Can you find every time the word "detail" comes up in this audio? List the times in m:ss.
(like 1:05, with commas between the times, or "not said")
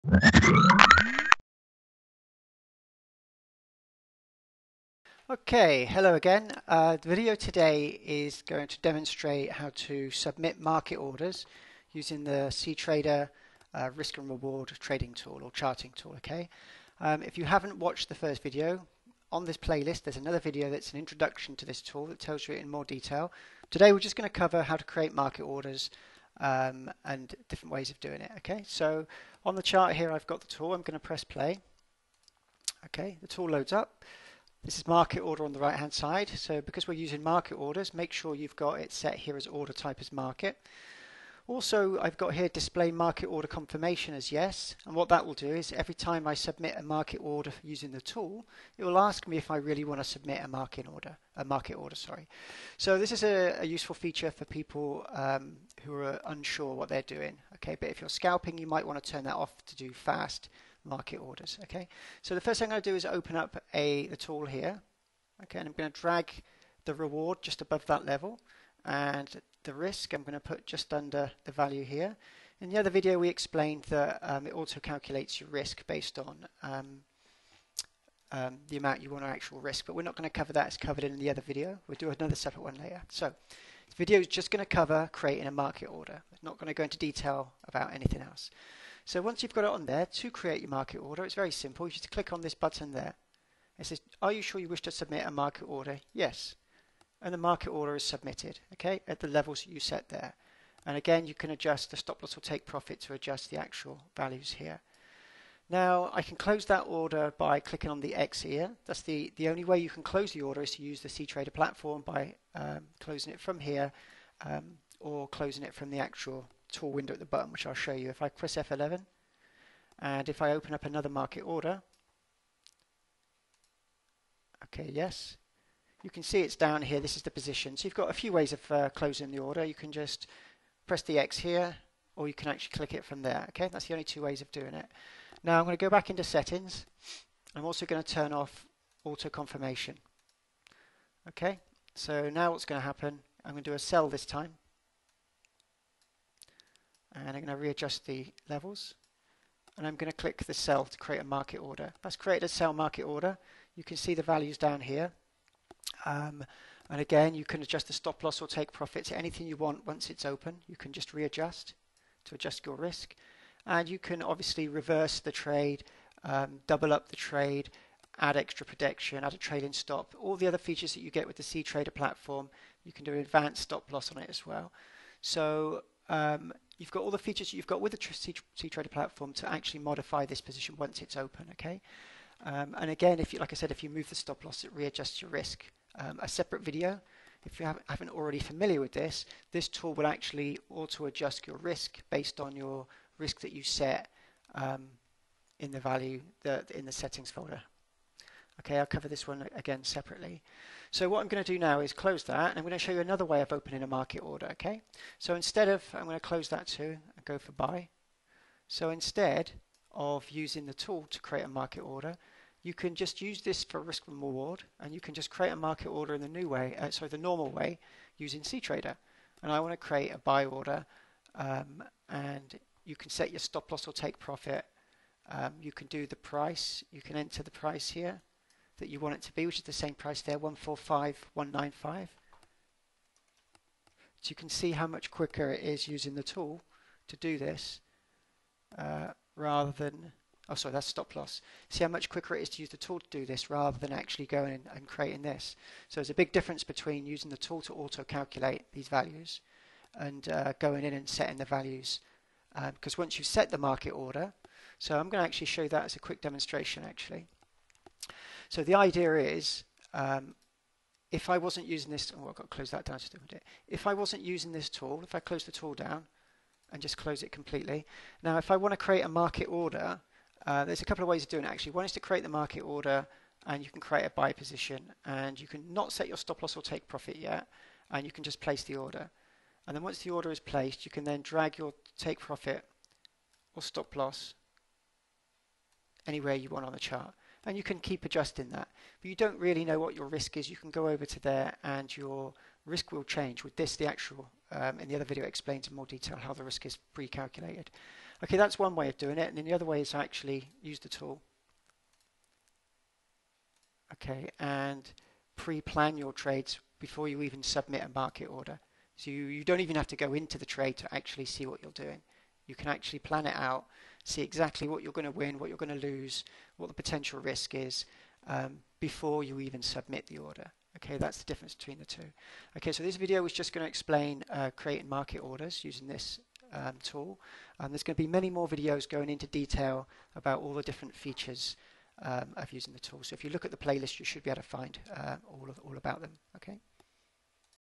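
0:22, 1:26, 4:55, 5:29.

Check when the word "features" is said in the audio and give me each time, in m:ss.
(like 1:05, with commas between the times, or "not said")
0:53, 2:50, 2:57, 5:30.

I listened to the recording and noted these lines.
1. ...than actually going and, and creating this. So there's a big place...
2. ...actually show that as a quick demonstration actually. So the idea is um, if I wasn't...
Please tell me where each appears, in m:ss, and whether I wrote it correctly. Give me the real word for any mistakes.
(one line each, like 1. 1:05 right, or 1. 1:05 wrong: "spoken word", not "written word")
1. 4:03 wrong: "difference", not "place"
2. 4:15 right.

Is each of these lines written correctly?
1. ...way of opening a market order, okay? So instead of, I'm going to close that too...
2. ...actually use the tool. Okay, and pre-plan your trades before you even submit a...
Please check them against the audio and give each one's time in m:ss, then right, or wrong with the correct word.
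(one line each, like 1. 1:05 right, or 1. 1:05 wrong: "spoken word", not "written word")
1. 3:23 right
2. 4:59 right.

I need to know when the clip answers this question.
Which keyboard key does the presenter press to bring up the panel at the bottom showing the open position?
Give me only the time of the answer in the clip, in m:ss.
1:58.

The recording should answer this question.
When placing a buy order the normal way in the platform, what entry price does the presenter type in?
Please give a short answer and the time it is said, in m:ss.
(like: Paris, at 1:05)
145.195, at 3:50.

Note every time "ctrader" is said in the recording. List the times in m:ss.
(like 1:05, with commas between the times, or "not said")
0:12, 1:51, 2:51, 2:58, 3:38.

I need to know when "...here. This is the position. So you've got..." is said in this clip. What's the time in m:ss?
2:06.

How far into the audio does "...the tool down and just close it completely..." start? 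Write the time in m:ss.
4:25.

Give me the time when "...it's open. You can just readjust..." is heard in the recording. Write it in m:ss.
2:40.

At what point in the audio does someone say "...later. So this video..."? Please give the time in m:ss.
1:22.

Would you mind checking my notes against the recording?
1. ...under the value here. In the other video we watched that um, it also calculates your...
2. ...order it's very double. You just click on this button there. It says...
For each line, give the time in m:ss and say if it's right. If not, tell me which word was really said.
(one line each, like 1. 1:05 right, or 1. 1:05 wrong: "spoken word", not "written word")
1. 1:10 wrong: "explained", not "watched"
2. 1:30 wrong: "simple", not "double".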